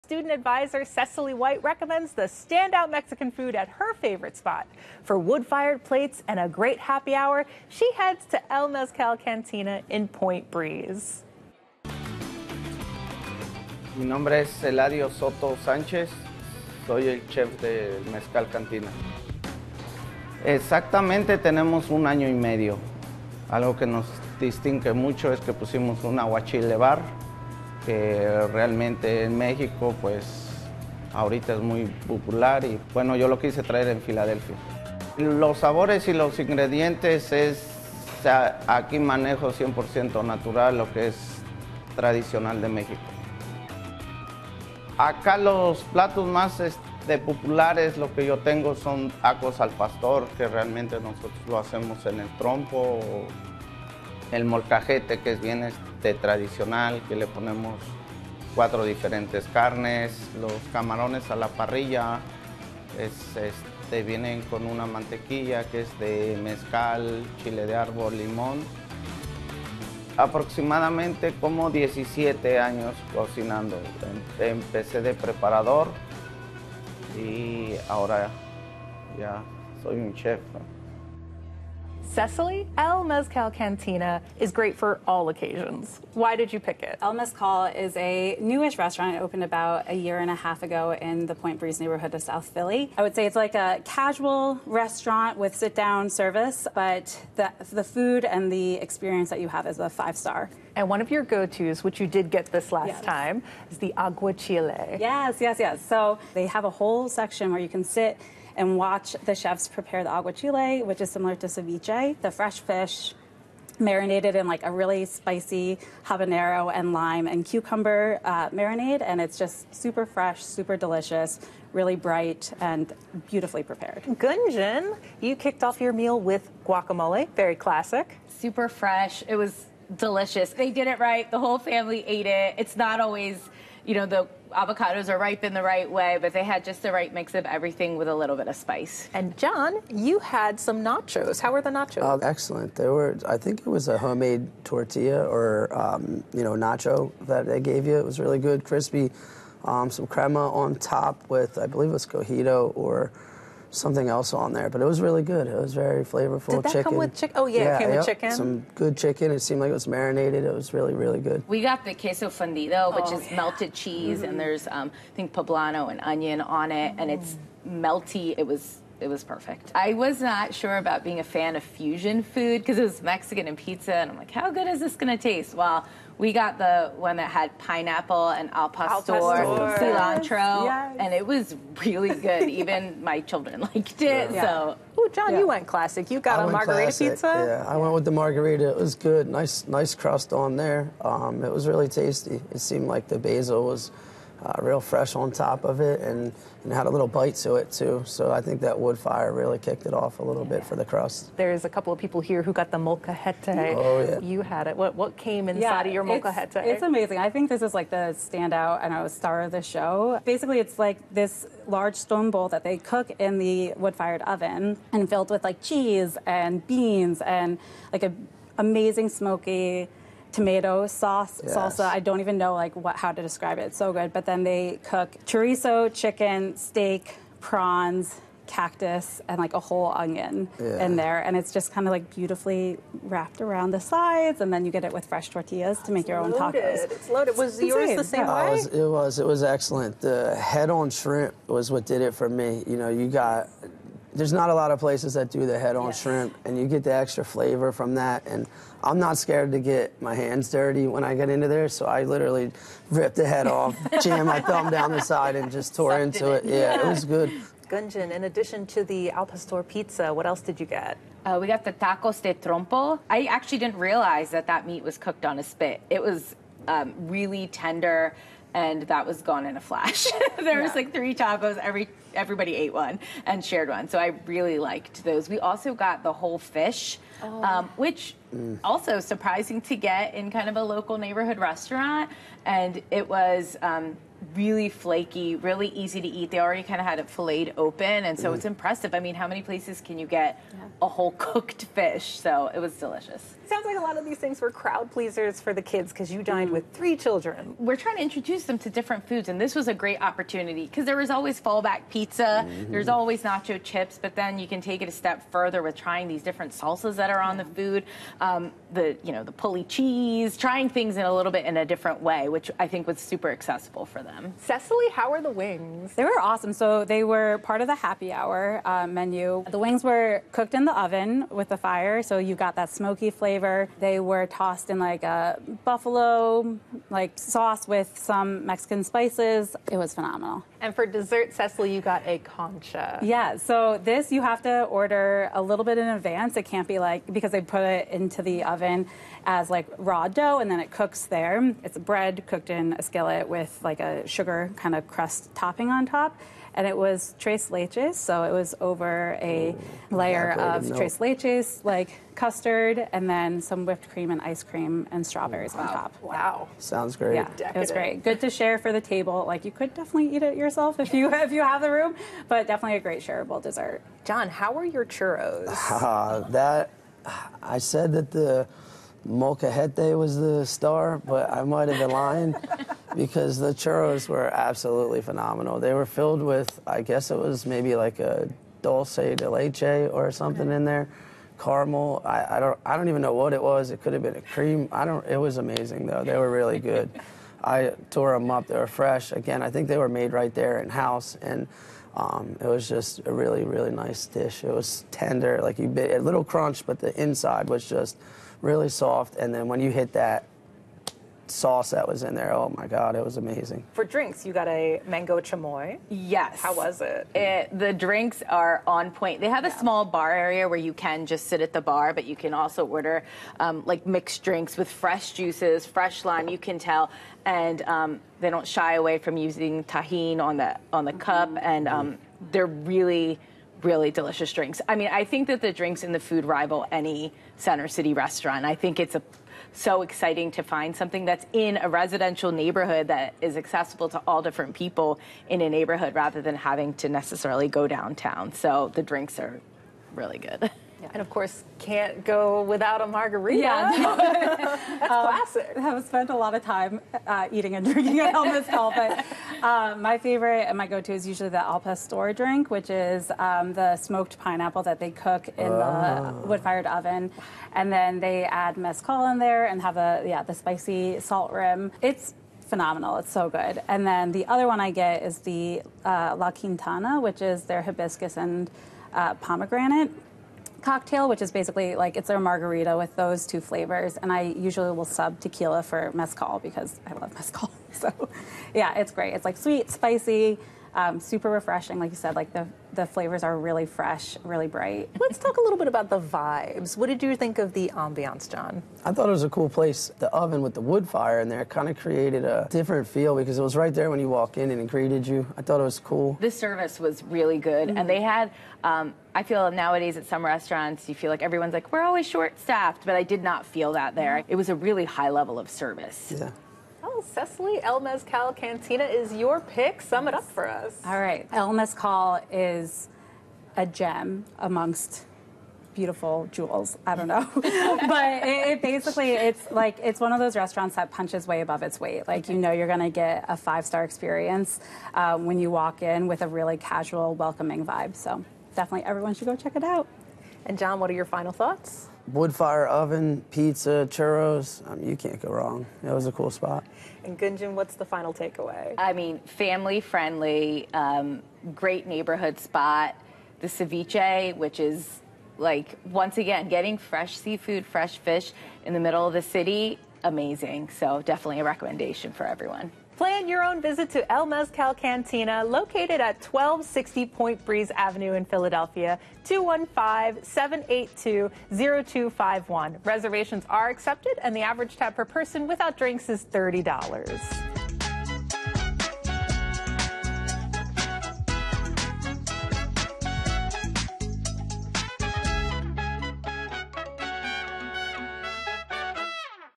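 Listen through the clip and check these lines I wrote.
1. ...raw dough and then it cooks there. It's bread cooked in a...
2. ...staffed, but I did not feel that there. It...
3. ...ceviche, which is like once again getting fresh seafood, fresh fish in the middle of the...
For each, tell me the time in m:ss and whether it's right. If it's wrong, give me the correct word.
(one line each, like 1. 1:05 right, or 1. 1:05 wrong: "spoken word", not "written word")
1. 5:39 right
2. 8:22 right
3. 9:03 right.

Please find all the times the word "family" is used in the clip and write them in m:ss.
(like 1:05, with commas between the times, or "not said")
2:11, 8:59.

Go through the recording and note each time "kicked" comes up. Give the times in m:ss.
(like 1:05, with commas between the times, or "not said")
2:05, 3:19.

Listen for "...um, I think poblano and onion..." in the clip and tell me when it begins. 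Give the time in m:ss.
2:44.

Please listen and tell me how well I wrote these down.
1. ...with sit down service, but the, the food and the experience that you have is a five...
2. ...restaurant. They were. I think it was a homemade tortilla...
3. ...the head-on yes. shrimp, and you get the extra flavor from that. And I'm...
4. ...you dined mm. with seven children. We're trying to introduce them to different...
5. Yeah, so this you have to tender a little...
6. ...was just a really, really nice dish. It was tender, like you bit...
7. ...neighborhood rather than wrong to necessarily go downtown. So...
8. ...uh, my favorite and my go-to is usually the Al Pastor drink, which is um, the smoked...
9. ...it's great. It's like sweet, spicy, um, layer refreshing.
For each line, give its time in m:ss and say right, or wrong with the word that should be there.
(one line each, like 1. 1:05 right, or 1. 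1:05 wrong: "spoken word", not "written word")
1. 1:35 right
2. 2:22 wrong: "excellent", not "restaurant"
3. 4:05 right
4. 4:56 wrong: "three", not "seven"
5. 5:33 wrong: "order", not "tender"
6. 6:32 right
7. 7:15 wrong: "having", not "wrong"
8. 7:29 right
9. 7:58 wrong: "super", not "layer".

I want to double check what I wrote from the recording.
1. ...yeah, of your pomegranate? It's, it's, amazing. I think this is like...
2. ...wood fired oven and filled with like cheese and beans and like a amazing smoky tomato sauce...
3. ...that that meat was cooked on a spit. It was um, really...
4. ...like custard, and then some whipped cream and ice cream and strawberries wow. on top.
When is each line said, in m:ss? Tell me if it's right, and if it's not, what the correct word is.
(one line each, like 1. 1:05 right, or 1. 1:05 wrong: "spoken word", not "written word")
1. 3:25 wrong: "molcajete", not "pomegranate"
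2. 3:33 right
3. 4:24 right
4. 5:51 right.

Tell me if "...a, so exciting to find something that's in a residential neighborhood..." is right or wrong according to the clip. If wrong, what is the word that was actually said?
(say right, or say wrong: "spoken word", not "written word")
right.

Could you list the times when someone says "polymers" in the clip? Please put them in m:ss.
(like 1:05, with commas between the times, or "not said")
not said.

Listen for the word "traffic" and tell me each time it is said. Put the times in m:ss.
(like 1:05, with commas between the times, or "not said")
not said.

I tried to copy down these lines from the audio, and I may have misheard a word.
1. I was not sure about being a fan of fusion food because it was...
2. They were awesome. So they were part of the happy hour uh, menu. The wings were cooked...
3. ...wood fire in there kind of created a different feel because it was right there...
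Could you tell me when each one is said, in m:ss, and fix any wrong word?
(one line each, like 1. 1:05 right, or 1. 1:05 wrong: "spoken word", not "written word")
1. 2:49 right
2. 5:15 right
3. 8:10 right.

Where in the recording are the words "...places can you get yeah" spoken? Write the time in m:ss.
4:49.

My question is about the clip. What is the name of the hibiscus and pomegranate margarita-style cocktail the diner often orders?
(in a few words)
La Quintana.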